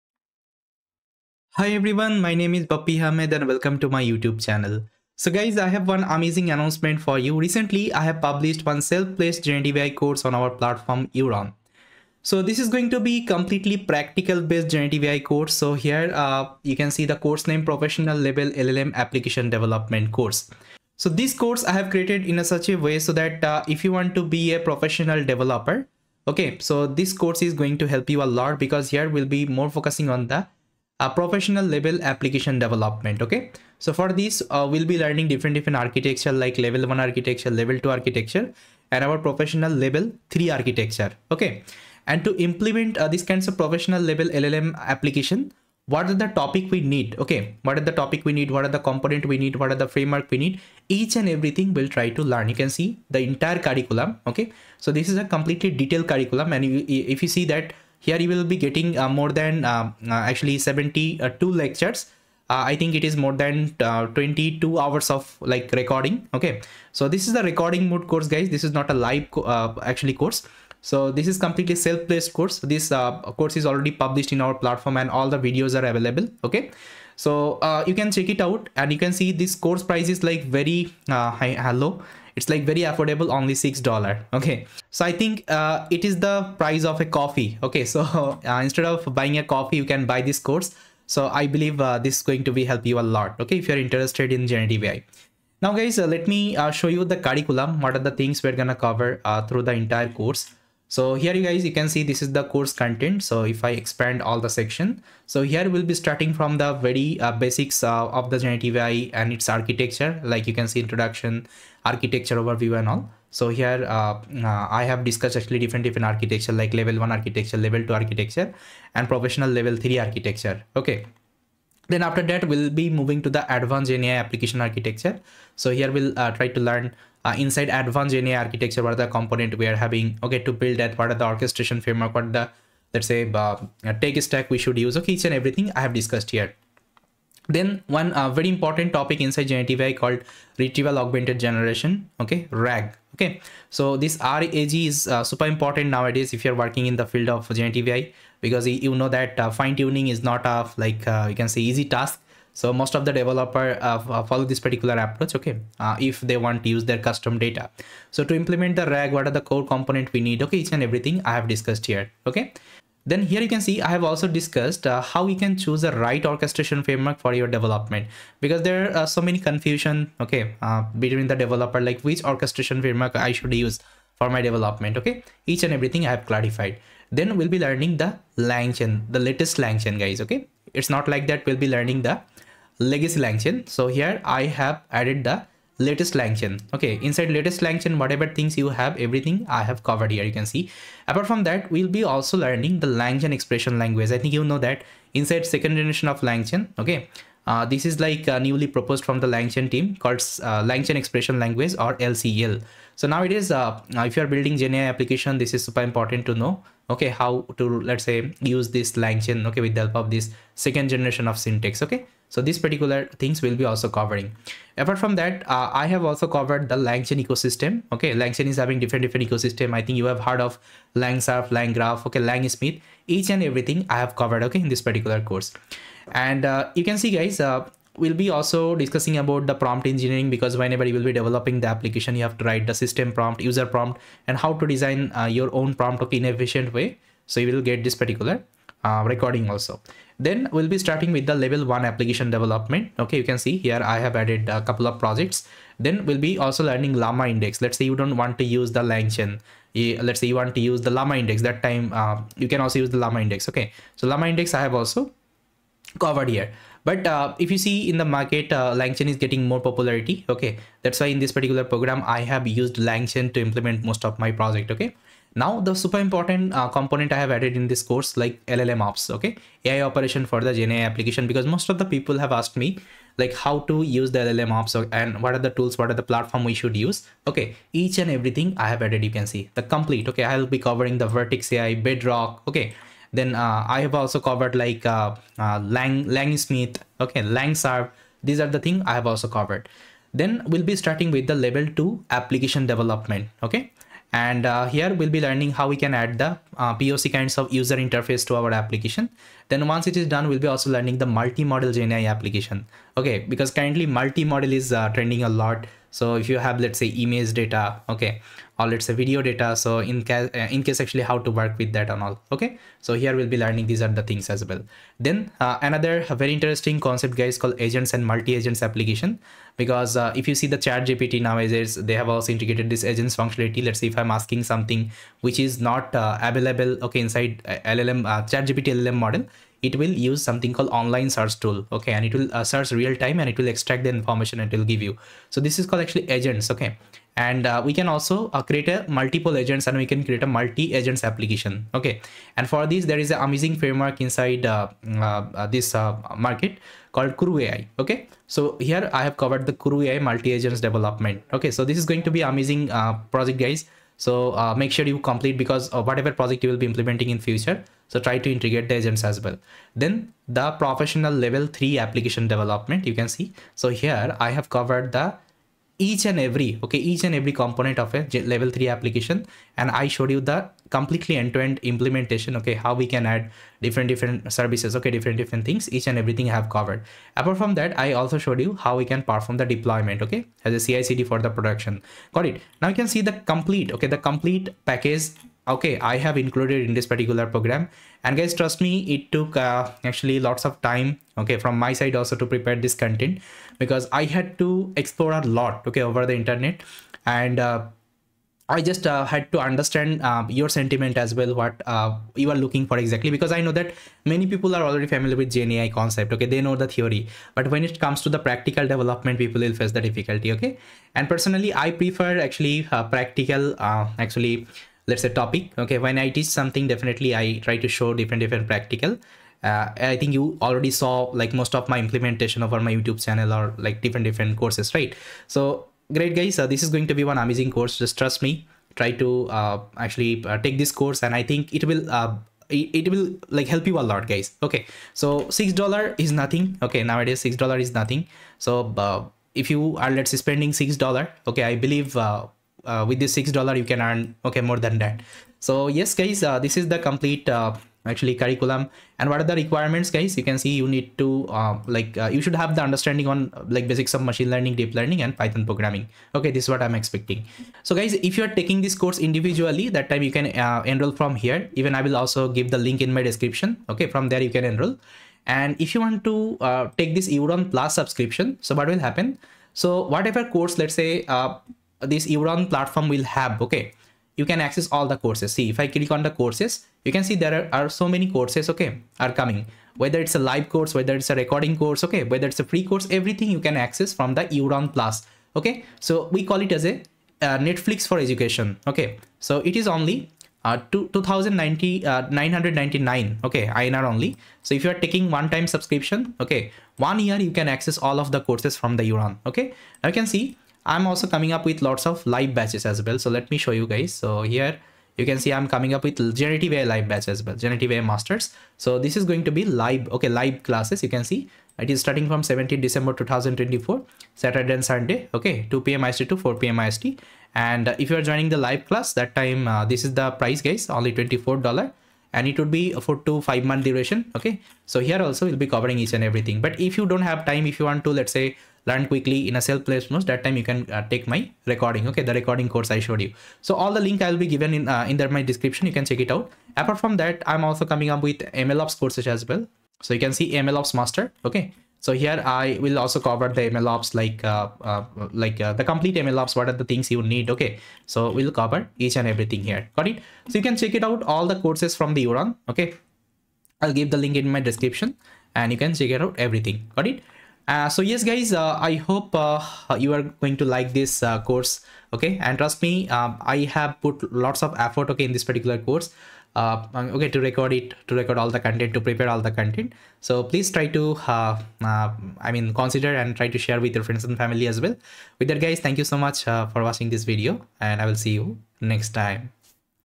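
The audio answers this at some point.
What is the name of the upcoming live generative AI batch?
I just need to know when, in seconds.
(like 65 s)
507 s.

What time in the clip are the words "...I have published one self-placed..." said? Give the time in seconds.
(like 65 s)
7 s.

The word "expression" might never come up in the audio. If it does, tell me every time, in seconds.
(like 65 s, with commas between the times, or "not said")
193 s, 200 s.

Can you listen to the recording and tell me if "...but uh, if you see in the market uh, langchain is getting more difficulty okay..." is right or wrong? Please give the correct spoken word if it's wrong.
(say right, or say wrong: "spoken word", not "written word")
wrong: "popularity", not "difficulty".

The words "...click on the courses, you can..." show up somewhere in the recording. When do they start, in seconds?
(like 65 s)
475 s.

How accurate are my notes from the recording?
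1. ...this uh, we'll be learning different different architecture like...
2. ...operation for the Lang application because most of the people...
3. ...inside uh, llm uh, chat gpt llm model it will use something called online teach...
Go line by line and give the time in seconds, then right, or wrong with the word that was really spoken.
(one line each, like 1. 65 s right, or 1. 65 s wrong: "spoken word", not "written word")
1. 34 s right
2. 269 s wrong: "GenAI", not "Lang"
3. 327 s wrong: "search", not "teach".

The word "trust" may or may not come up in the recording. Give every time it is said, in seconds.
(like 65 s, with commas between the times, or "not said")
388 s, 427 s, 562 s.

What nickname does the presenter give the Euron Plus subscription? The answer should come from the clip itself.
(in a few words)
Netflix for education.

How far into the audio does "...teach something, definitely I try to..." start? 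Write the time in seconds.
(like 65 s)
416 s.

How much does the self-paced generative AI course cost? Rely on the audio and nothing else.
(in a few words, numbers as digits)
$6.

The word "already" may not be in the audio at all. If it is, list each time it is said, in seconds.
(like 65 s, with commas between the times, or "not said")
73 s, 404 s, 420 s.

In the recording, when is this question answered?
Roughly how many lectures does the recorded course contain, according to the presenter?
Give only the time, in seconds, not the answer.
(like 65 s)
60 s.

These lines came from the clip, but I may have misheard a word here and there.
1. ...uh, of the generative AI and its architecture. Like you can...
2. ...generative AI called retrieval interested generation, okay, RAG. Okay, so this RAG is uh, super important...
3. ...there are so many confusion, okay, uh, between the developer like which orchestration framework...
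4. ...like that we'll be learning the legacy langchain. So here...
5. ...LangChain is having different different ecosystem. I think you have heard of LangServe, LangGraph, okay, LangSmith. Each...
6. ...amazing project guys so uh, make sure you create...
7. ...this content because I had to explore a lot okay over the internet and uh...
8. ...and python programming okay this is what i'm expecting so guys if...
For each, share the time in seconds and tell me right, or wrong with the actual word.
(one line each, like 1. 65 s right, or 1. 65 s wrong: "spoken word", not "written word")
1. 107 s right
2. 139 s wrong: "augmented", not "interested"
3. 168 s right
4. 181 s right
5. 218 s right
6. 352 s wrong: "complete", not "create"
7. 392 s right
8. 455 s right.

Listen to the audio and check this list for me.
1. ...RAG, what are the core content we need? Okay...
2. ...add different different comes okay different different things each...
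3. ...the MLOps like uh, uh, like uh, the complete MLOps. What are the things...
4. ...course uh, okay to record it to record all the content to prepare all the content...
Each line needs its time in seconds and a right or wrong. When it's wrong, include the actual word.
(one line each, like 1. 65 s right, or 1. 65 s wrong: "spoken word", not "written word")
1. 158 s wrong: "component", not "content"
2. 373 s wrong: "services", not "comes"
3. 543 s right
4. 565 s right.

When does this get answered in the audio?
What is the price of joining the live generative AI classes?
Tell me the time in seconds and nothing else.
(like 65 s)
520 s.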